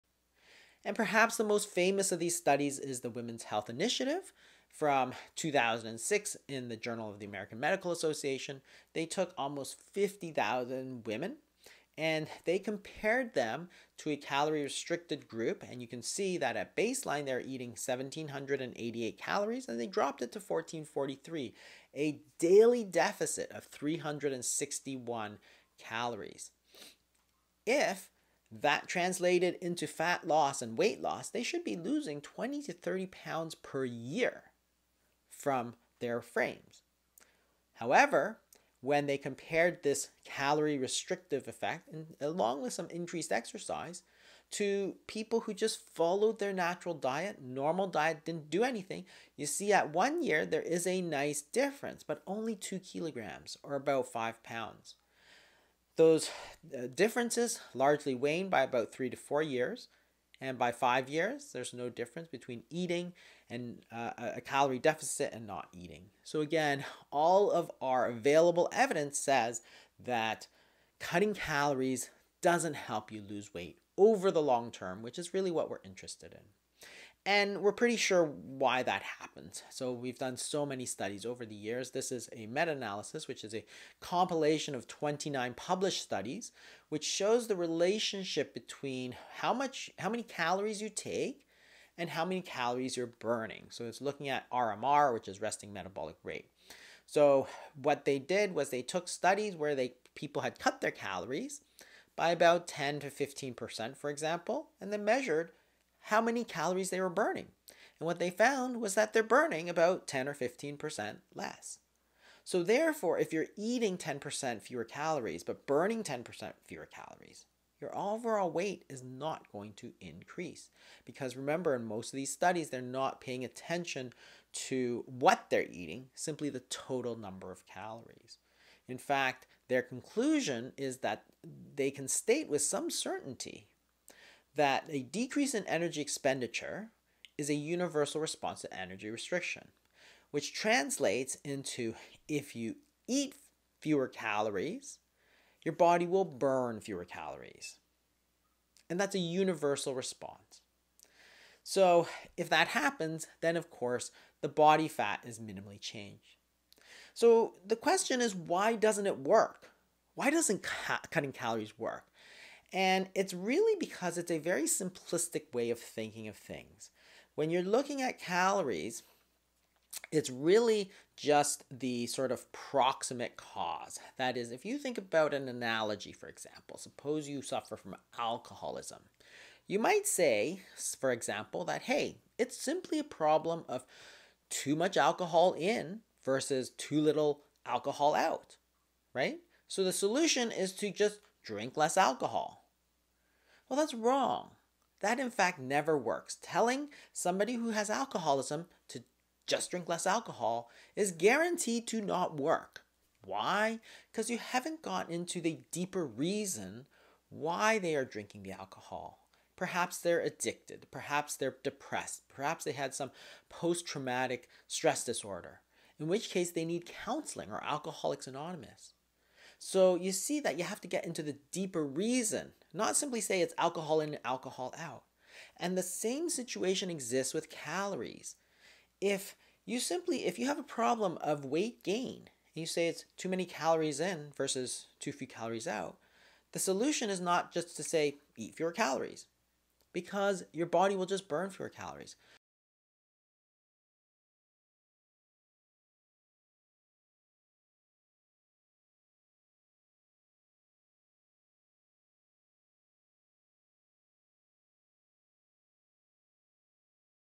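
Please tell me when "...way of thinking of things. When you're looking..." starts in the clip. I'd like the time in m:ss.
2:45.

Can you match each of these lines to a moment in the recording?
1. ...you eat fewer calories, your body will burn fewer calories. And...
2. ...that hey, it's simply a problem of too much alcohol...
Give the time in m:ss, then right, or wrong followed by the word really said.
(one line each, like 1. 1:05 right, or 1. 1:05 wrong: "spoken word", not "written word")
1. 2:22 right
2. 3:01 right.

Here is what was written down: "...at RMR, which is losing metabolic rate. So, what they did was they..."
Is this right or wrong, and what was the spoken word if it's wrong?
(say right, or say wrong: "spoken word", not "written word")
wrong: "resting", not "losing".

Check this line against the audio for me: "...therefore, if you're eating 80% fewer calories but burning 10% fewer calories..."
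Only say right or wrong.
wrong.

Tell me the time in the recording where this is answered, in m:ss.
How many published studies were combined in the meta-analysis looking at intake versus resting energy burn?
1:24.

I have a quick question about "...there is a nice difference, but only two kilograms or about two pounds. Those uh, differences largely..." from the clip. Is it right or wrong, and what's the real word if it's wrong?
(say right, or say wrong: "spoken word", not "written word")
wrong: "five", not "two".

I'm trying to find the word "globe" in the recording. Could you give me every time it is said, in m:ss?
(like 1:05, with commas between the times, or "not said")
not said.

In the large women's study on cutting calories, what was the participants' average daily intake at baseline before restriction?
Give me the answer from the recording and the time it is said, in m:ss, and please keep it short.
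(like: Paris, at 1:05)
1,788 calories, at 0:17.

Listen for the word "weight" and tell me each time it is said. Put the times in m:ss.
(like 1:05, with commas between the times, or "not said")
0:30, 1:13, 1:58, 3:51.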